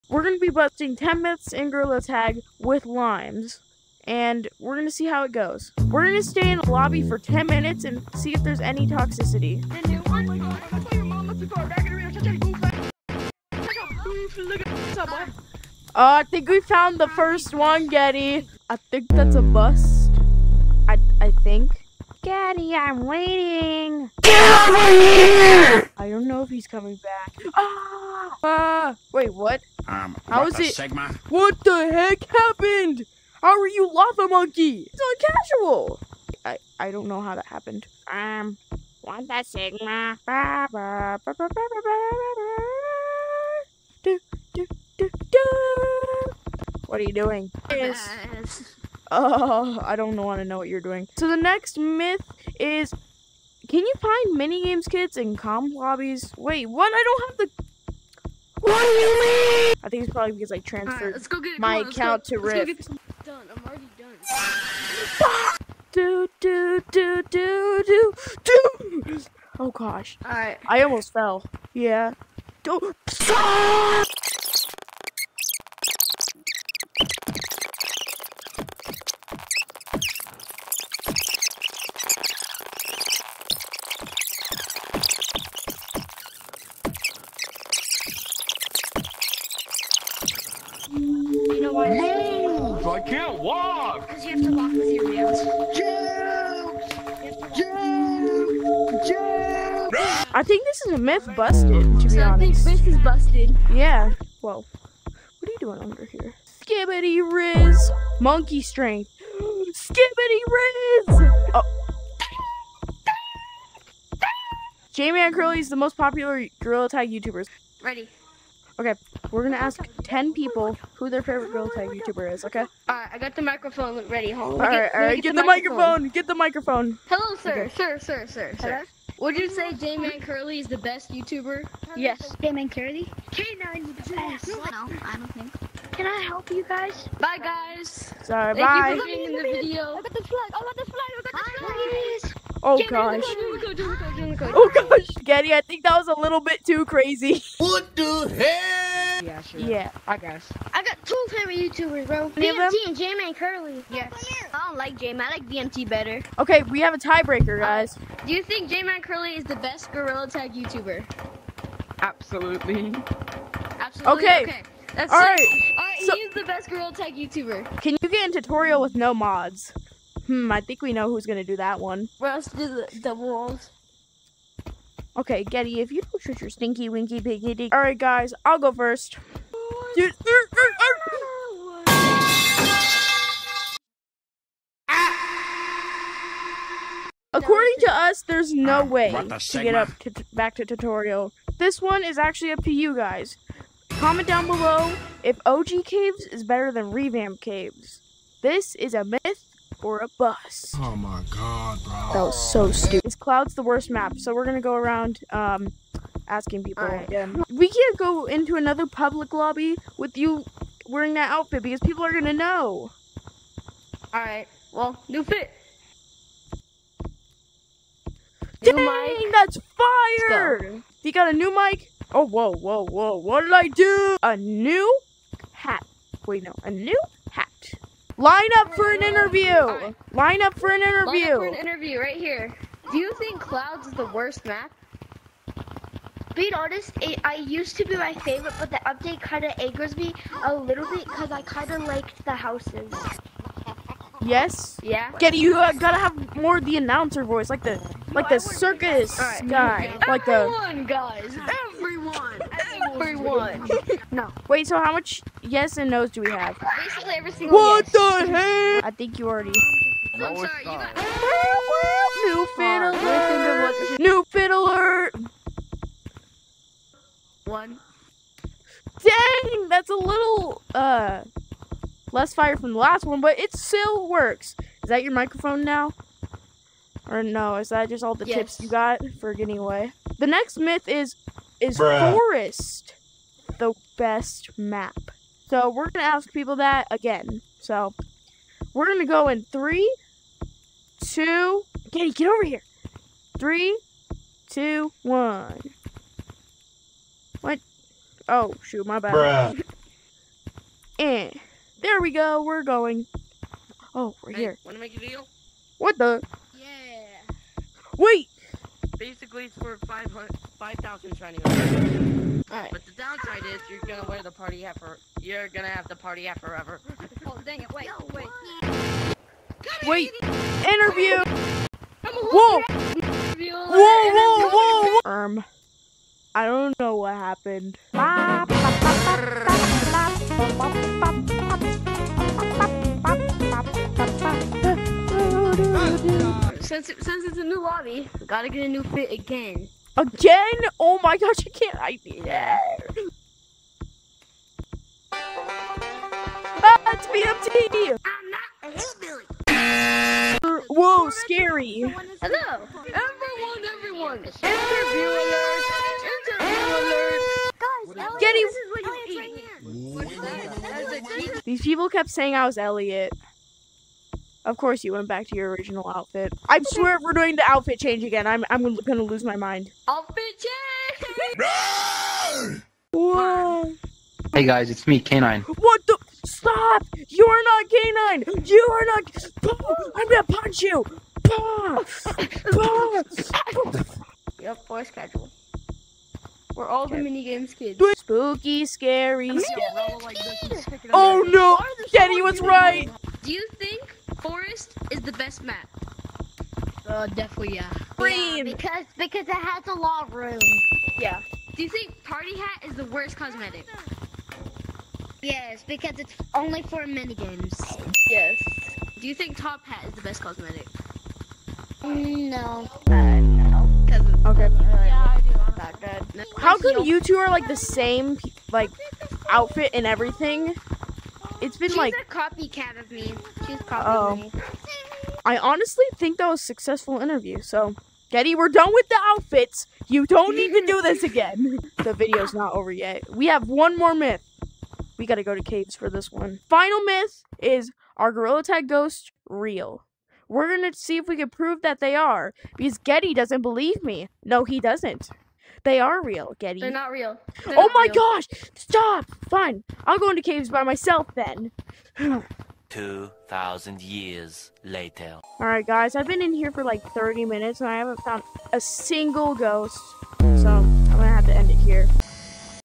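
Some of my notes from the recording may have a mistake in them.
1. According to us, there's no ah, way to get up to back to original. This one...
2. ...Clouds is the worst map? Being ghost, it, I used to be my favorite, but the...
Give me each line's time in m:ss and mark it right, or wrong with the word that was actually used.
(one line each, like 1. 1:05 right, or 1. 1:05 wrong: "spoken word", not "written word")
1. 3:07 wrong: "tutorial", not "original"
2. 3:53 wrong: "honest", not "ghost".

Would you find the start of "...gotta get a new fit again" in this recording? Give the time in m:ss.
5:38.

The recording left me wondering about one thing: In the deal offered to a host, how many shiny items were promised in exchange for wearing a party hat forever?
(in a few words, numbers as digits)
5,000.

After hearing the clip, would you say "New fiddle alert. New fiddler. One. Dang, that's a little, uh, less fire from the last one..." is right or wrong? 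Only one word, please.
right.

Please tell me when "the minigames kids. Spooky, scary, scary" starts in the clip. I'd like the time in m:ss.
6:27.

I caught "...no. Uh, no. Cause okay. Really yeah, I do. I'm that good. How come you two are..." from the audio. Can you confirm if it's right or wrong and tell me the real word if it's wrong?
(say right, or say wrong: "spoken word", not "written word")
right.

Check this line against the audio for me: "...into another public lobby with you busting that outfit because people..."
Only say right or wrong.
wrong.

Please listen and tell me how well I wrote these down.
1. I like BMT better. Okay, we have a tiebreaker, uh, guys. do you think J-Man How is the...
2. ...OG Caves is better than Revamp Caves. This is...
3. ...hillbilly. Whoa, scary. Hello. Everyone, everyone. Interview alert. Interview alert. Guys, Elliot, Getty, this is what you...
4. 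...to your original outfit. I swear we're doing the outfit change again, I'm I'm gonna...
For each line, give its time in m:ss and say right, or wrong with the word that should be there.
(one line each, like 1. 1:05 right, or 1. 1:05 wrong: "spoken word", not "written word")
1. 2:35 wrong: "Curly", not "How"
2. 3:15 right
3. 5:50 right
4. 6:05 right.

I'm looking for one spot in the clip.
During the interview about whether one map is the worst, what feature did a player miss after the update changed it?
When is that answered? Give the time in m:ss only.
4:02.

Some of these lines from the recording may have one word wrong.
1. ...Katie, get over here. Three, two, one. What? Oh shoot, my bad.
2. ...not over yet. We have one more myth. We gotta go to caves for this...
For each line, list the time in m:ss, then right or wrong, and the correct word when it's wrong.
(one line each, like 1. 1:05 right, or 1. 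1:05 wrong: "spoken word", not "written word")
1. 4:51 right
2. 7:12 right.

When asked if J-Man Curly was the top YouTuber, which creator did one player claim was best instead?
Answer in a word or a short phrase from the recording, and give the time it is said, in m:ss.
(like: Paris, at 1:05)
K9, at 2:13.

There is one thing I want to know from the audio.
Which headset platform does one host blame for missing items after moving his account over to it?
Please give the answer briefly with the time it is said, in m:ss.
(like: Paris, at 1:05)
Rift, at 1:02.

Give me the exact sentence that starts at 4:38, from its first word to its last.
tips you got for getting away?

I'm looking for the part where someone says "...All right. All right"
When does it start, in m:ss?
2:45.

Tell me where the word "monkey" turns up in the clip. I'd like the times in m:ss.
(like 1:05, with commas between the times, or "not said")
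0:34, 1:48.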